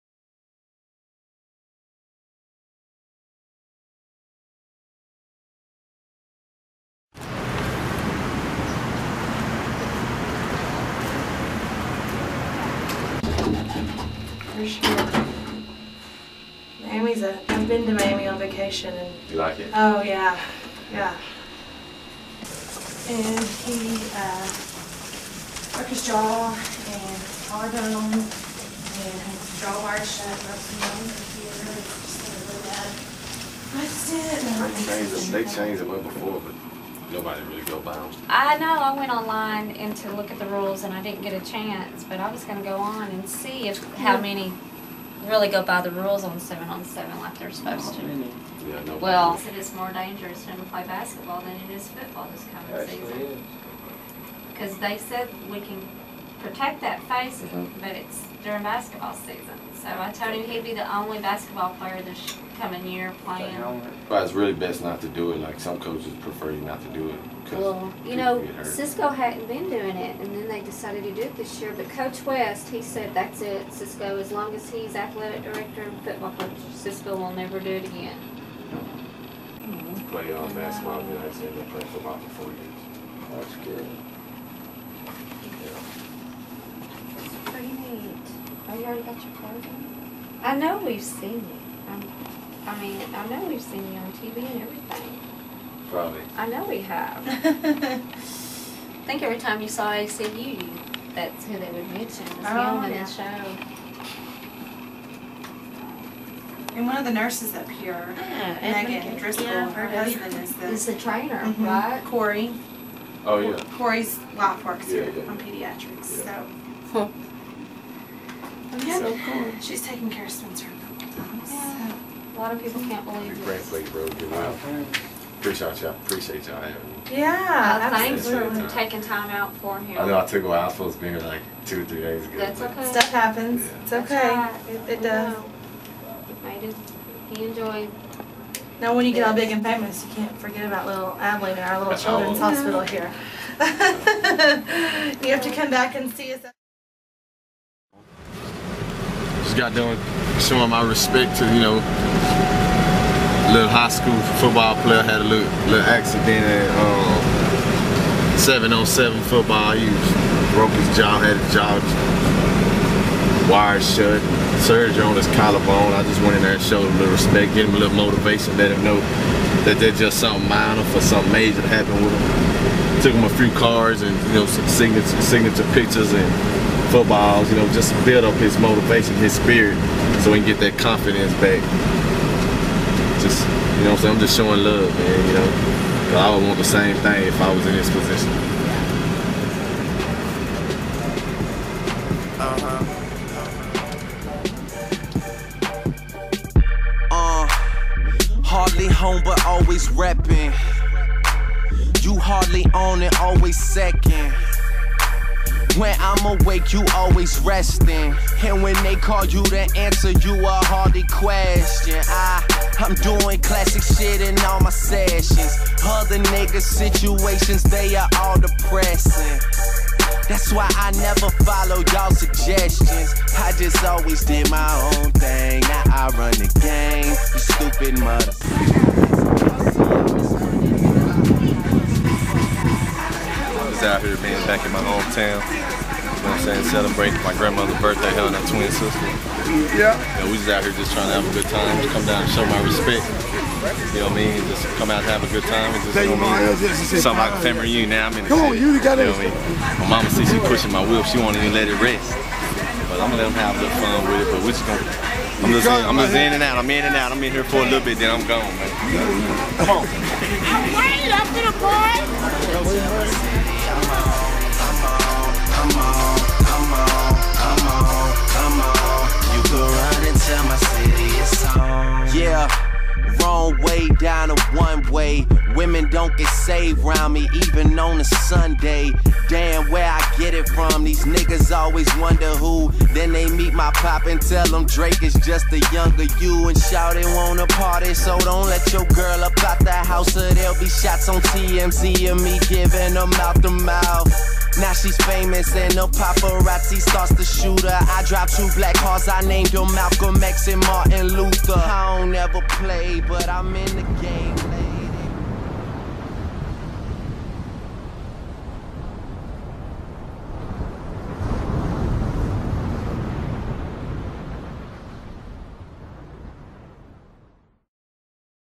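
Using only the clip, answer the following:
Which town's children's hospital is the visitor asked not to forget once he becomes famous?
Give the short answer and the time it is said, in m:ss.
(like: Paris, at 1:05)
Abilene, at 2:21.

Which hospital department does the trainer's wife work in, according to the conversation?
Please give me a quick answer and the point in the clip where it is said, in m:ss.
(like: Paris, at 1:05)
Pediatrics, at 1:55.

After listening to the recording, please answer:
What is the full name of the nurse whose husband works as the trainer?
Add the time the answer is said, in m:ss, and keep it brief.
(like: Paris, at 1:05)
Megan Driscoll, at 1:48.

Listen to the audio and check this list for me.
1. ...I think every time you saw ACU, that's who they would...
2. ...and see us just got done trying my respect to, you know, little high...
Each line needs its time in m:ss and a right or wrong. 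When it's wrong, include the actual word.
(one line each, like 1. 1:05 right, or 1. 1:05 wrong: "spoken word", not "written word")
1. 1:37 right
2. 2:25 wrong: "showing", not "trying".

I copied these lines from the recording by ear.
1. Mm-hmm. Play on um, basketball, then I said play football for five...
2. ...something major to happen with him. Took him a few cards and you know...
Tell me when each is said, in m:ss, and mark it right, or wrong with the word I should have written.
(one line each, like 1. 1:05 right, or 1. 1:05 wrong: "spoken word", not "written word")
1. 1:18 wrong: "four", not "five"
2. 2:51 right.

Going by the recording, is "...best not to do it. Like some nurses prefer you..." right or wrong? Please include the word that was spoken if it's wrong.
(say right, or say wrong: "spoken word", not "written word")
wrong: "coaches", not "nurses".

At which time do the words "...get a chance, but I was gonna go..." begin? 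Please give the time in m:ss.
0:41.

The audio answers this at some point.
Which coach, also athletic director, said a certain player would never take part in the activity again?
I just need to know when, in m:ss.
1:11.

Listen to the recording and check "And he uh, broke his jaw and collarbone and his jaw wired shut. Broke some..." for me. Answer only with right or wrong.
right.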